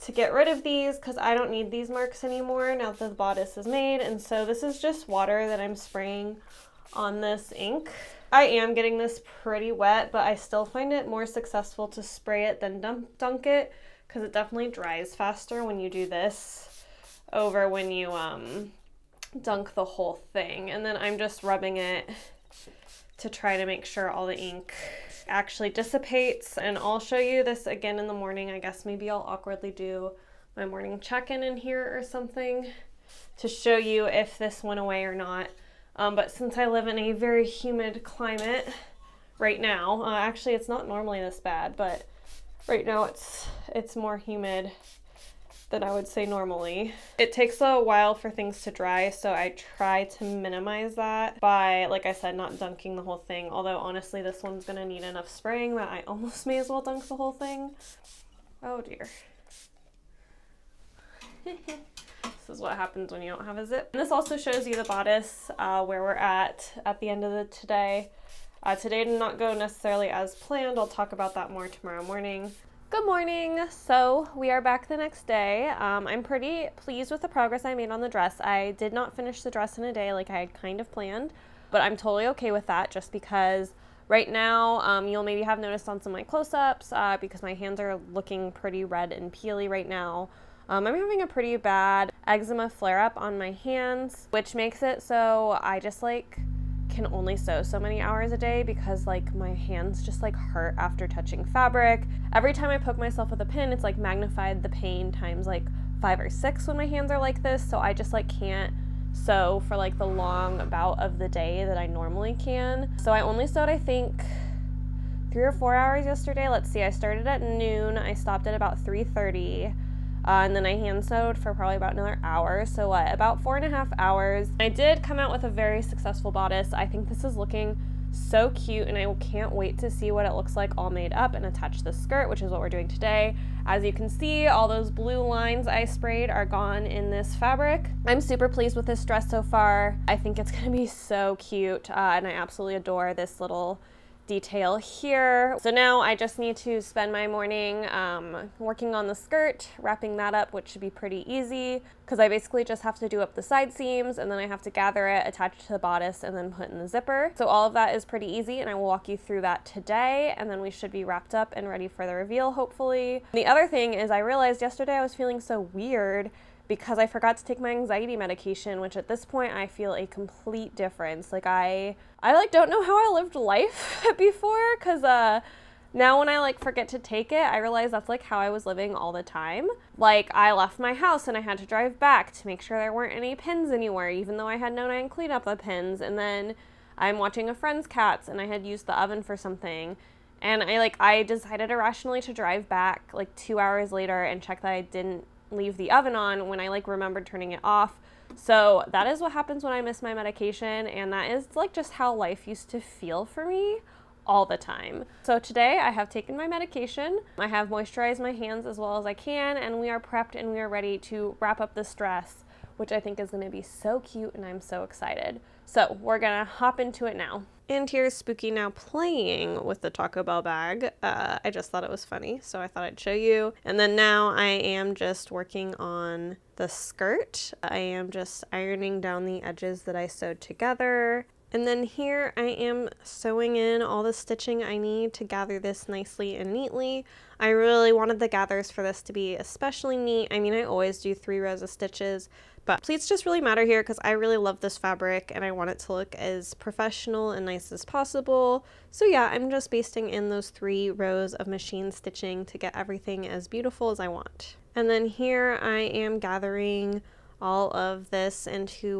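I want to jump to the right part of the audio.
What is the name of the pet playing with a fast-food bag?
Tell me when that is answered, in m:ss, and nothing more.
3:38.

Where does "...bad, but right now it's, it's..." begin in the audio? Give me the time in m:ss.
0:41.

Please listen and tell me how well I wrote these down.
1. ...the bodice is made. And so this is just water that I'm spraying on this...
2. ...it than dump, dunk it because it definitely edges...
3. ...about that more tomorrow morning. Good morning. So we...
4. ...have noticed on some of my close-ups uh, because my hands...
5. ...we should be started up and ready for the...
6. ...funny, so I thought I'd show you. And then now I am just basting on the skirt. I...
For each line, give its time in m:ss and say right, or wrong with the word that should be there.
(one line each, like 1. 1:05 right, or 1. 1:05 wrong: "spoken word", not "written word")
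1. 0:02 right
2. 0:12 wrong: "dries", not "edges"
3. 1:11 right
4. 1:25 right
5. 2:40 wrong: "wrapped", not "started"
6. 3:42 wrong: "working", not "basting".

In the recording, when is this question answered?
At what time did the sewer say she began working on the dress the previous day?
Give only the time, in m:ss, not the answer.
1:57.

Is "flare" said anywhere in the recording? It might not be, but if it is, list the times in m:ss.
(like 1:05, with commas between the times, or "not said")
1:32.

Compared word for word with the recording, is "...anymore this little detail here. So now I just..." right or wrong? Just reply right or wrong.
wrong.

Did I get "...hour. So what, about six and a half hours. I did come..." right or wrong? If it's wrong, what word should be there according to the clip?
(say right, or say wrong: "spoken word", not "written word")
wrong: "four", not "six".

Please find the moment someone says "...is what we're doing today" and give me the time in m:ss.
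2:12.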